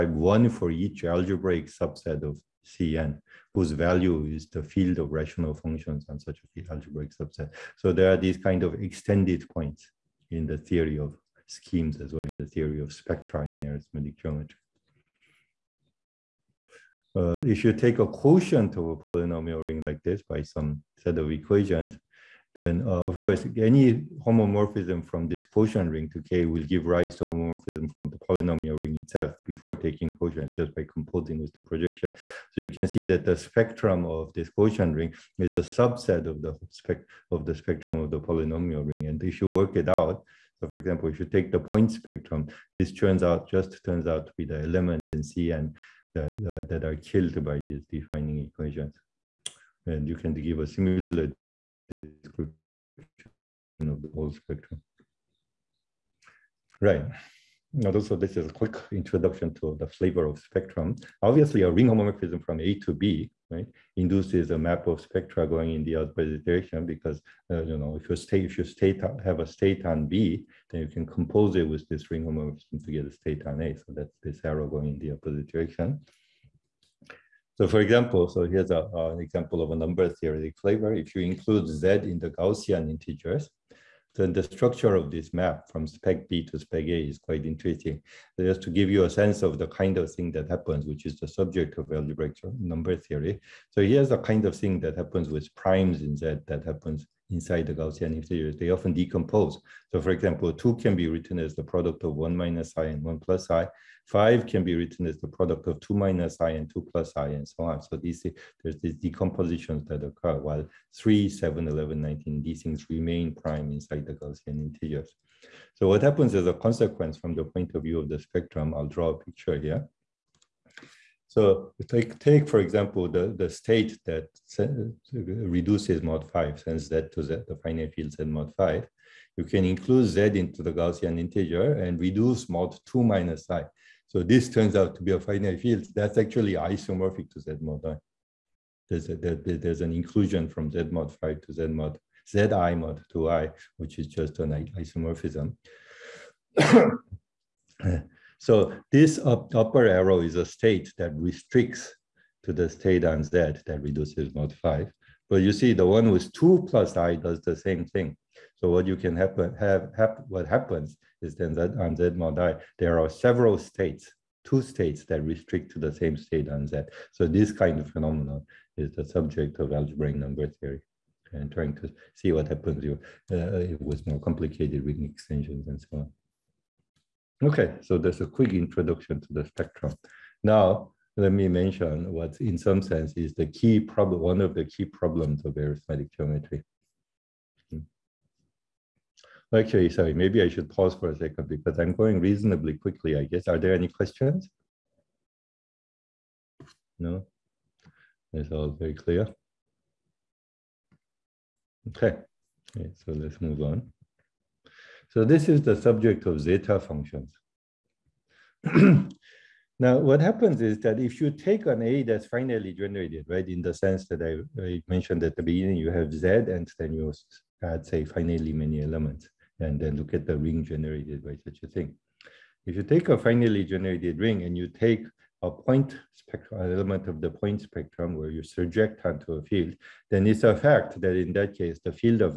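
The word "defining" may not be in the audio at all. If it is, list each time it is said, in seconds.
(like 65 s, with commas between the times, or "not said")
47 s.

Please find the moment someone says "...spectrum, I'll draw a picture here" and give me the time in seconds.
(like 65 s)
118 s.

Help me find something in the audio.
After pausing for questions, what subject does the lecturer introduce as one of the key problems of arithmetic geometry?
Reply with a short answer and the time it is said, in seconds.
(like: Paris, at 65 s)
zeta functions, at 206 s.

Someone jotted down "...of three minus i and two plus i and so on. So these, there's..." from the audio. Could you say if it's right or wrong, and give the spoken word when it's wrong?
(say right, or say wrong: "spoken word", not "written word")
wrong: "two", not "three".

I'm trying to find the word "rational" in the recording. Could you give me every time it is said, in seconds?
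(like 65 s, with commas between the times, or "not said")
5 s.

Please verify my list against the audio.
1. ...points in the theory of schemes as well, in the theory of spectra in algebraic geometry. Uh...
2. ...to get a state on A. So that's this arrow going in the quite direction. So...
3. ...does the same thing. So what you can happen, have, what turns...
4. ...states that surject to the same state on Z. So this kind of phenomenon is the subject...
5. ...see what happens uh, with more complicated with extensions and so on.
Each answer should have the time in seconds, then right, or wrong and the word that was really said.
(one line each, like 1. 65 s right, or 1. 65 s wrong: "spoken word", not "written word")
1. 9 s wrong: "arithmetic", not "algebraic"
2. 72 s wrong: "opposite", not "quite"
3. 157 s wrong: "happens", not "turns"
4. 164 s wrong: "restrict", not "surject"
5. 172 s right.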